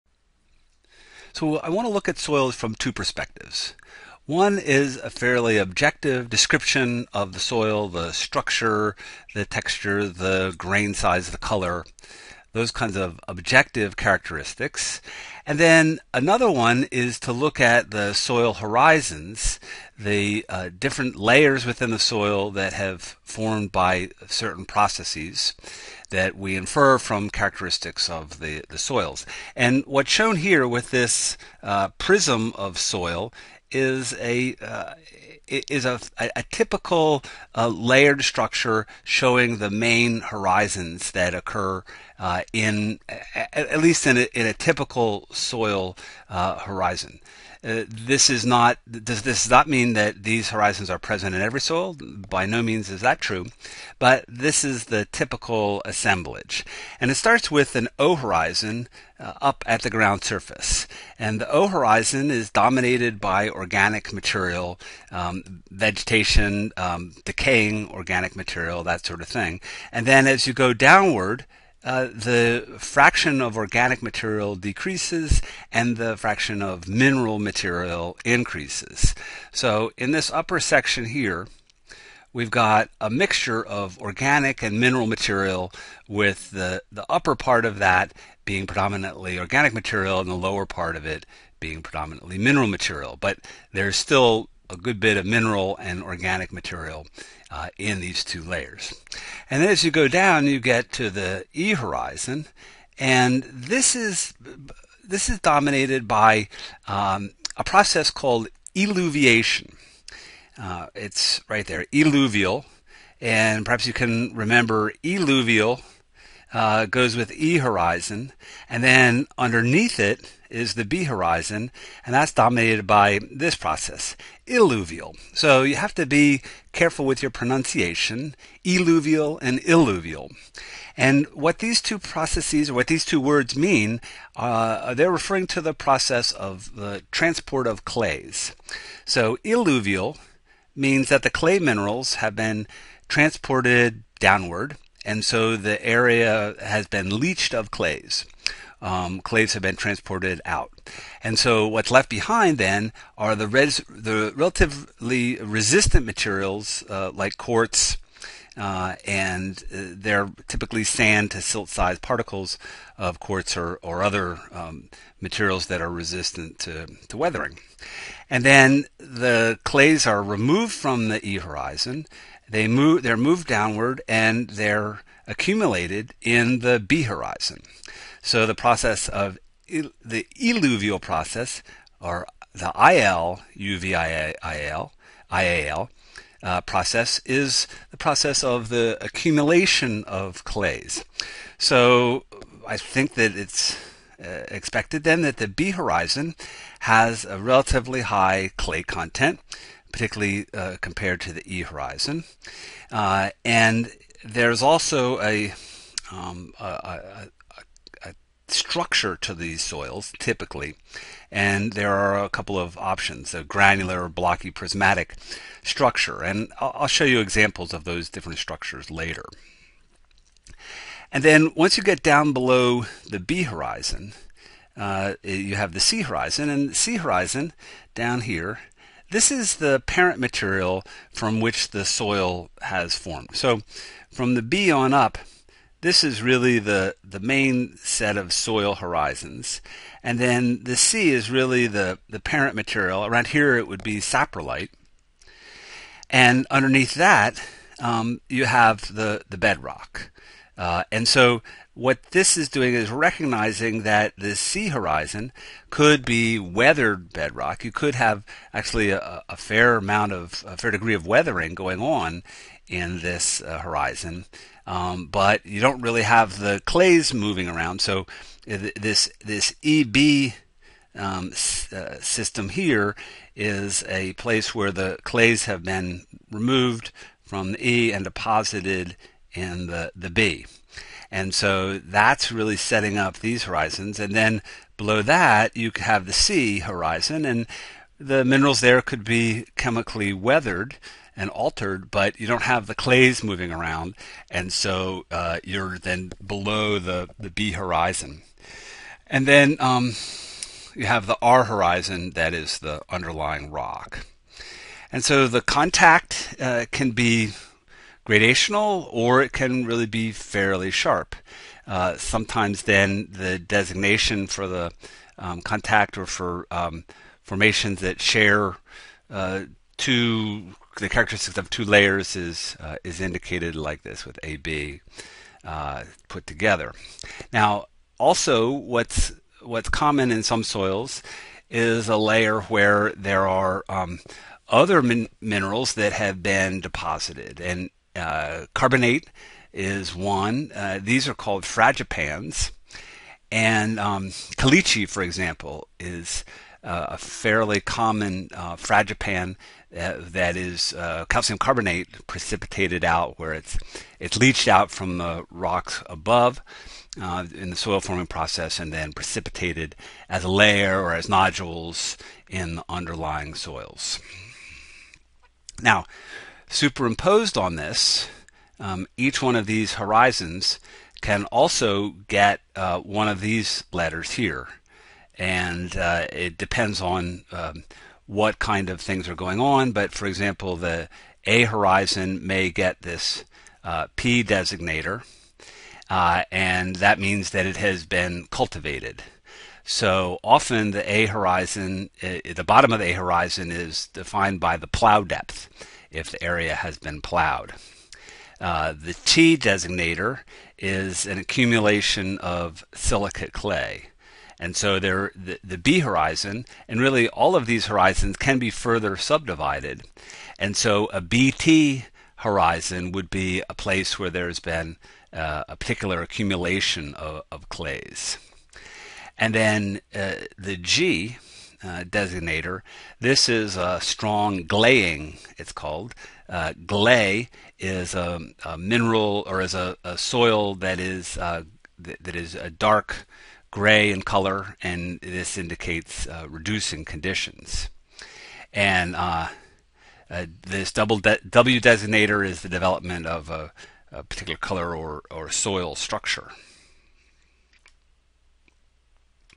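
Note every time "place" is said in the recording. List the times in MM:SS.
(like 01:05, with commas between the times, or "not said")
04:34, 06:53.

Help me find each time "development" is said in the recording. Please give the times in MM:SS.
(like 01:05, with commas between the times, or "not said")
07:22.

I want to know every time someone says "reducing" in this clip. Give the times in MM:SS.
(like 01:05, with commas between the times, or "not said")
07:16.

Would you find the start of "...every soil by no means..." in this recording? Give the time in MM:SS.
00:51.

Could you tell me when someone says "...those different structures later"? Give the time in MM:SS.
03:37.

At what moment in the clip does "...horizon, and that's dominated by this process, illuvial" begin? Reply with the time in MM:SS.
02:01.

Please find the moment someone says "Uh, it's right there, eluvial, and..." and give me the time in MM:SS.
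01:50.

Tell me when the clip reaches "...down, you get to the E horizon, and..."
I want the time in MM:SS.
01:40.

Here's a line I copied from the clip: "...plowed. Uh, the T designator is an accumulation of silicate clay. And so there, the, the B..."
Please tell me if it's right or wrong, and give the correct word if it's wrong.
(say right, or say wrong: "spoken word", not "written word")
right.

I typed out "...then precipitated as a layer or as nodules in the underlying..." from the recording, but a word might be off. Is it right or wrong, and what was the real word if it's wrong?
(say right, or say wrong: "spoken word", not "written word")
right.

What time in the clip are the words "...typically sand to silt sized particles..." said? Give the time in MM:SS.
02:40.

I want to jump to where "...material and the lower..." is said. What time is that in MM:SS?
01:29.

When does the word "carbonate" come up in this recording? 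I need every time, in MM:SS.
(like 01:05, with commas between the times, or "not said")
05:38, 05:51.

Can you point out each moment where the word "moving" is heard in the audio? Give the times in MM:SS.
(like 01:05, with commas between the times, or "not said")
04:27, 04:53.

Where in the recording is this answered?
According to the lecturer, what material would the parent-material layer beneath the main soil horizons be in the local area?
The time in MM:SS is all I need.
04:03.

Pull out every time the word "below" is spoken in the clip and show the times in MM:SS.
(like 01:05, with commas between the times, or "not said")
03:42, 04:44, 04:56.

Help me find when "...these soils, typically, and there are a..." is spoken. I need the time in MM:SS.
03:29.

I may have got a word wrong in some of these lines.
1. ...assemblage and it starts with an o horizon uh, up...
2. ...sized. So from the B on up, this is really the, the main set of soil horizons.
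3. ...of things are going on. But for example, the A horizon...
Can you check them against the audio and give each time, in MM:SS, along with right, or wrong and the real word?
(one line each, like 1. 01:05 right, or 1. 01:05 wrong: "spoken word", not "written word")
1. 00:55 right
2. 03:52 wrong: "formed", not "sized"
3. 06:18 right.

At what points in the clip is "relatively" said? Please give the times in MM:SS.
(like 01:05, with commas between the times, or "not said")
02:34, 03:17.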